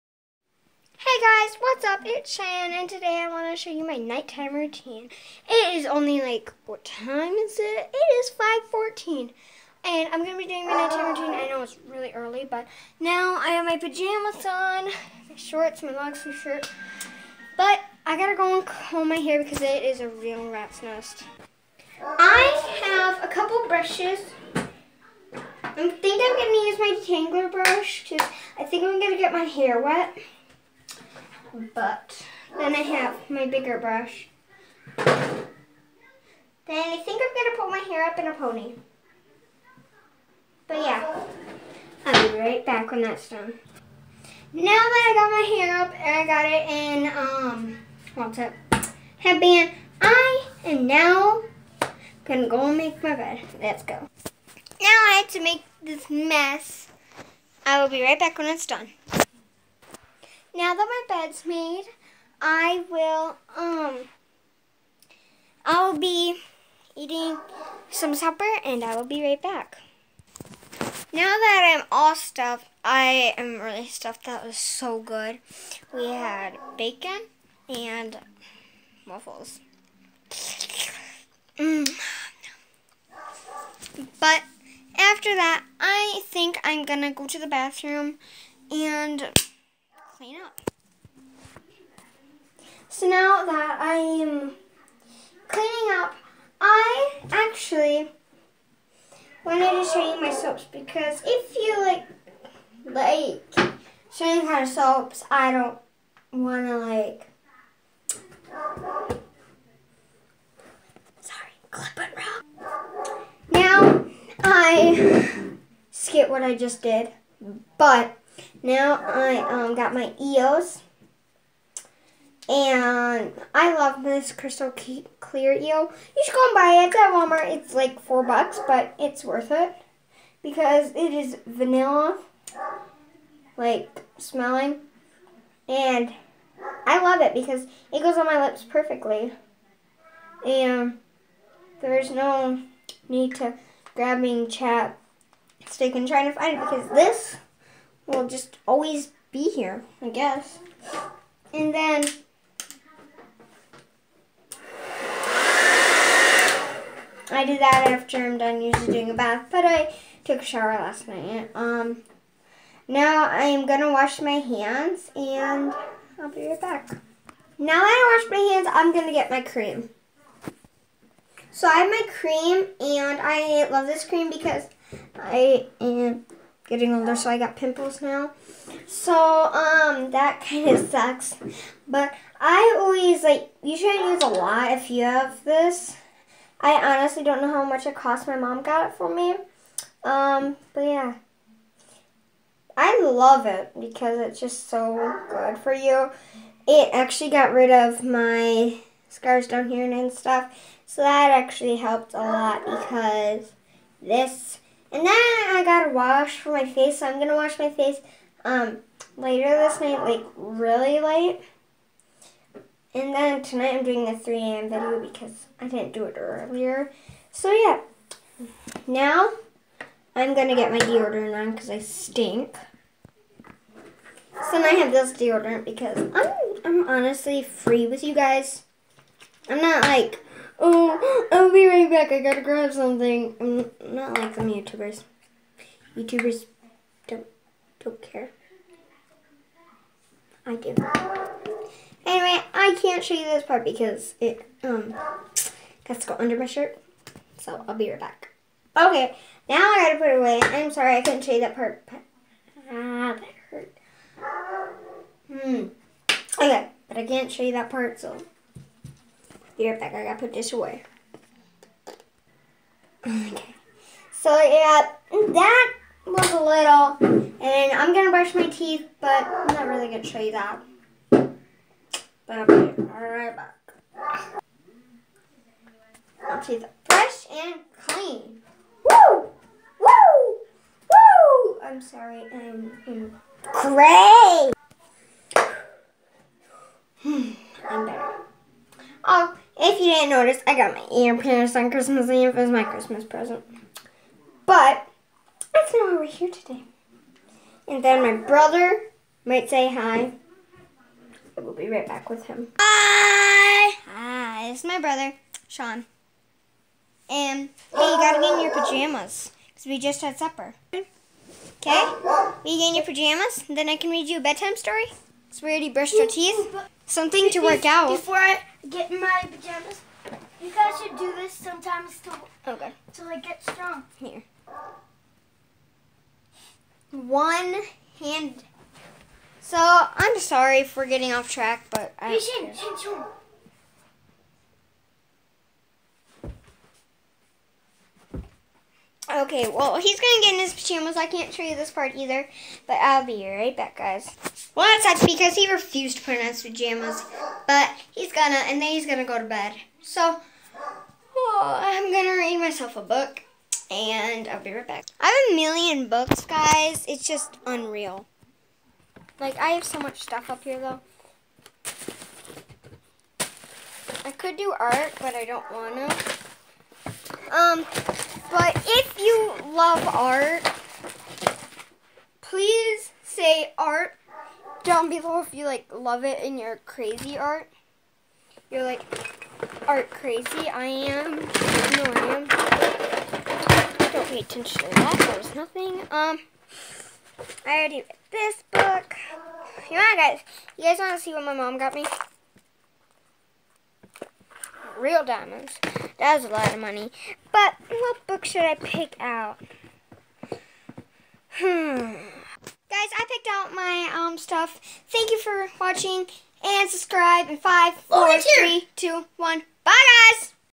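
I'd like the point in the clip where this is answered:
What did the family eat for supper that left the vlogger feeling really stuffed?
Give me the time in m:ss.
1:16.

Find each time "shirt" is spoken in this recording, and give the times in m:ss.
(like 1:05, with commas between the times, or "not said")
0:16, 4:06.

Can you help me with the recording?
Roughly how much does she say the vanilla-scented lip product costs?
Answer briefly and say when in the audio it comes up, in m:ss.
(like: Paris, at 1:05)
4 bucks, at 2:08.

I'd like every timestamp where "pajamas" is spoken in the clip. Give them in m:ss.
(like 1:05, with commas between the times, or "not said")
0:13, 5:08, 5:12, 5:19, 5:40, 5:46.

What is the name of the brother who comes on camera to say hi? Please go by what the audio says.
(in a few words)
Sean.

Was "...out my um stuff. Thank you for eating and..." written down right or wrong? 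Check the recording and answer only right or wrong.
wrong.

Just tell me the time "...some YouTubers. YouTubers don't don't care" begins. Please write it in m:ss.
3:54.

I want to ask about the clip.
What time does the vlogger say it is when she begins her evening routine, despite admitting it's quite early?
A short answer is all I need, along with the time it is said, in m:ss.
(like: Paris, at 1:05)
5:14, at 0:09.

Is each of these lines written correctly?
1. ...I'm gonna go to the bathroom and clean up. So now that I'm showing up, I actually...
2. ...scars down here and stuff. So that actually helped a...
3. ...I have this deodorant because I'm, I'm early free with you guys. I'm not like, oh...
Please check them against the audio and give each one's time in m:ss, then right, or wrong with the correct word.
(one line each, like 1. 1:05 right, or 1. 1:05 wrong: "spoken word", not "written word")
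1. 1:26 wrong: "cleaning", not "showing"
2. 3:19 right
3. 3:44 wrong: "honestly", not "early".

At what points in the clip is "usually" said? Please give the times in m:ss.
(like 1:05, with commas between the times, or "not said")
2:38, 3:03.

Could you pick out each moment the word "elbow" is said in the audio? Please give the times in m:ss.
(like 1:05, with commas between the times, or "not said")
not said.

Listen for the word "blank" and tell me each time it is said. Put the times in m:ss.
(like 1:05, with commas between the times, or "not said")
not said.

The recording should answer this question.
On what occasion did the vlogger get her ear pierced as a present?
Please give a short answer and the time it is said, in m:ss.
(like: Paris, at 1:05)
Christmas Eve, at 4:51.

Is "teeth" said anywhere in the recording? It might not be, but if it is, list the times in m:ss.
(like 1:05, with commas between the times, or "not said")
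4:28, 4:36, 5:16.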